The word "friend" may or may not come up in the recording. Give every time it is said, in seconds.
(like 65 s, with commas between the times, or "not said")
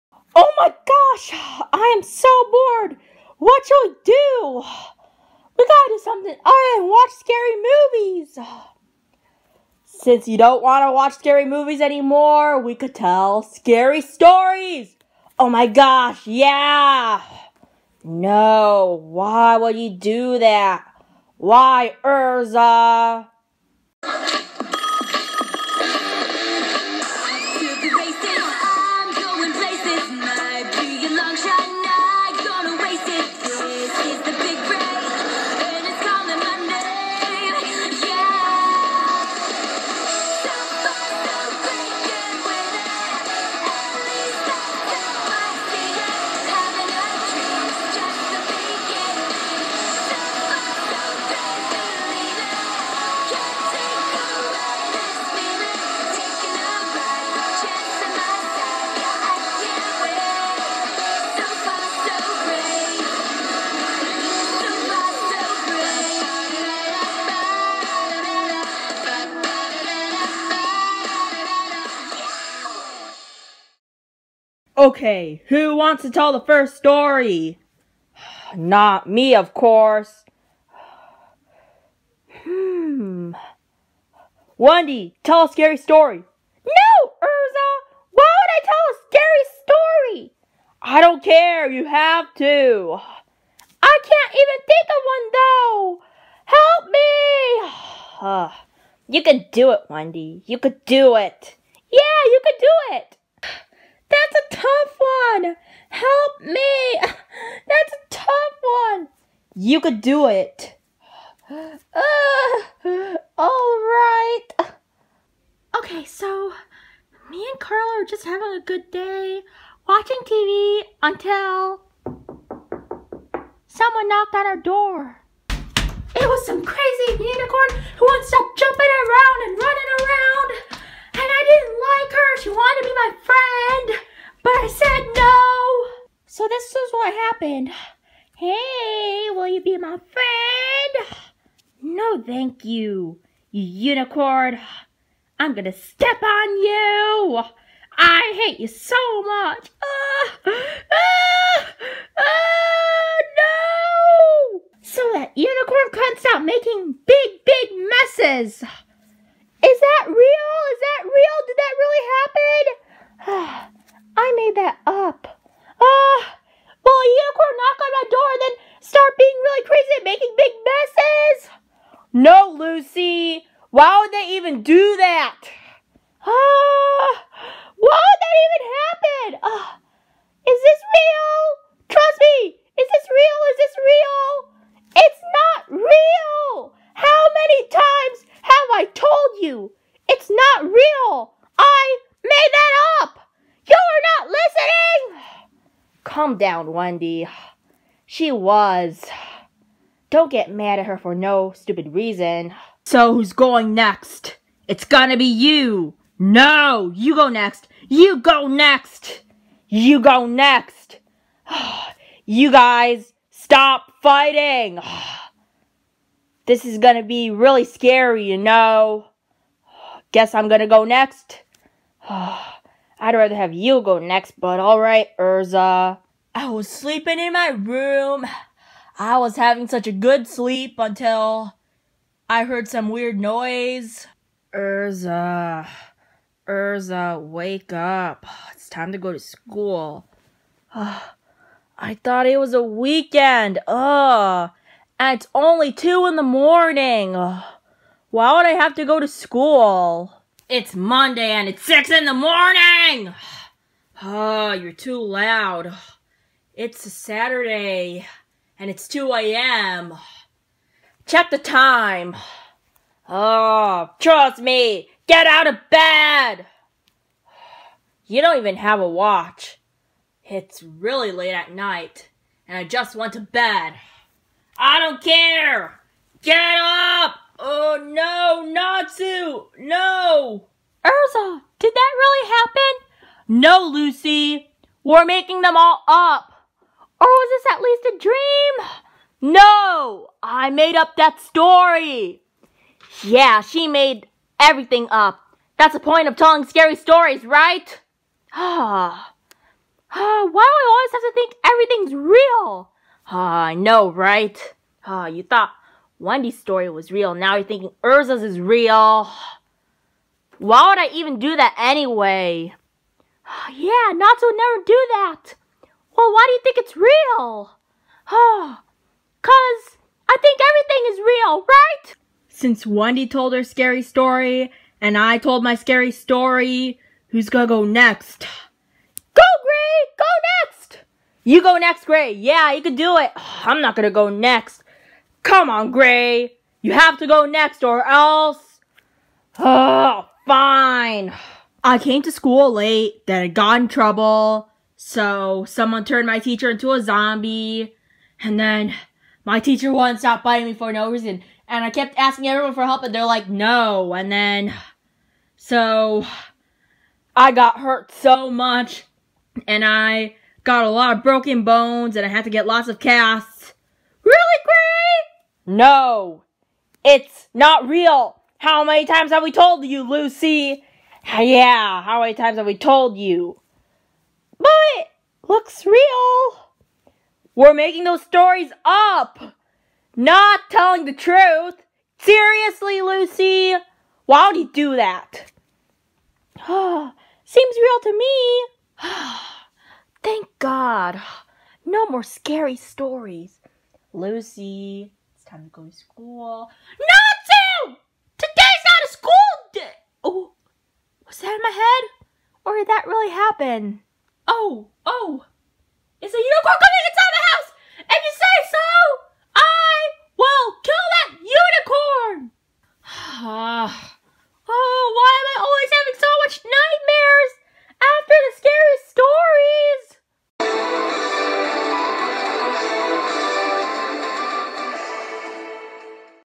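133 s, 140 s.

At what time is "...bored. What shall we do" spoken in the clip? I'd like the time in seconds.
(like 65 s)
2 s.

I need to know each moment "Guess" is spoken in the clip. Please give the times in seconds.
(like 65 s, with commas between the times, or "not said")
220 s.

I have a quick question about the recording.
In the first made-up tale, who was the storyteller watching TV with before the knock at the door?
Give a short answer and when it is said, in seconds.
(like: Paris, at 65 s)
Carla, at 117 s.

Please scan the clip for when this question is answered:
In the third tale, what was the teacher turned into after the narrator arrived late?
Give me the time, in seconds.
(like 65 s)
346 s.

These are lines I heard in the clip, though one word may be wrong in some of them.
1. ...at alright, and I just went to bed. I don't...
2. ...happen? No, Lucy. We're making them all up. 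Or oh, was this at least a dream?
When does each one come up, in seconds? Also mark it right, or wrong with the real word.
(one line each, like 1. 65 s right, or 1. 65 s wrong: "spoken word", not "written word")
1. 271 s wrong: "night", not "alright"
2. 282 s right.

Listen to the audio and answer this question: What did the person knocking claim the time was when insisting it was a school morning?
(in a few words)
6 in the morning.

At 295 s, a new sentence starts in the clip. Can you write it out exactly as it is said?
That's the point of telling scary stories, right?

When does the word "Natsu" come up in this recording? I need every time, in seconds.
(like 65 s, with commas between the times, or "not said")
278 s, 313 s.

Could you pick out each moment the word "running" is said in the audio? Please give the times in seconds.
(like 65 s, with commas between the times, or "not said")
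129 s.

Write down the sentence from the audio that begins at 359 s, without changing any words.
And I got a lot of broken bones and I had to get lots of casts.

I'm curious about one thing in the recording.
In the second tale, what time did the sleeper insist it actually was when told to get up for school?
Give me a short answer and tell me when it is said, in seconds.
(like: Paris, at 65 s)
2 a.m., at 258 s.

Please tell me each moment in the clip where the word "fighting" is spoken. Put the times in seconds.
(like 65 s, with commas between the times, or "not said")
214 s.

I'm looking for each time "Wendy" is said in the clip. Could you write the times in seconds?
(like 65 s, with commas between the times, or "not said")
84 s, 99 s, 196 s, 305 s, 322 s.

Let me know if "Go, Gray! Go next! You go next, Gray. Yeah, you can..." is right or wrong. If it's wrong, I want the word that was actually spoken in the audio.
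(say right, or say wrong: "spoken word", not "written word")
right.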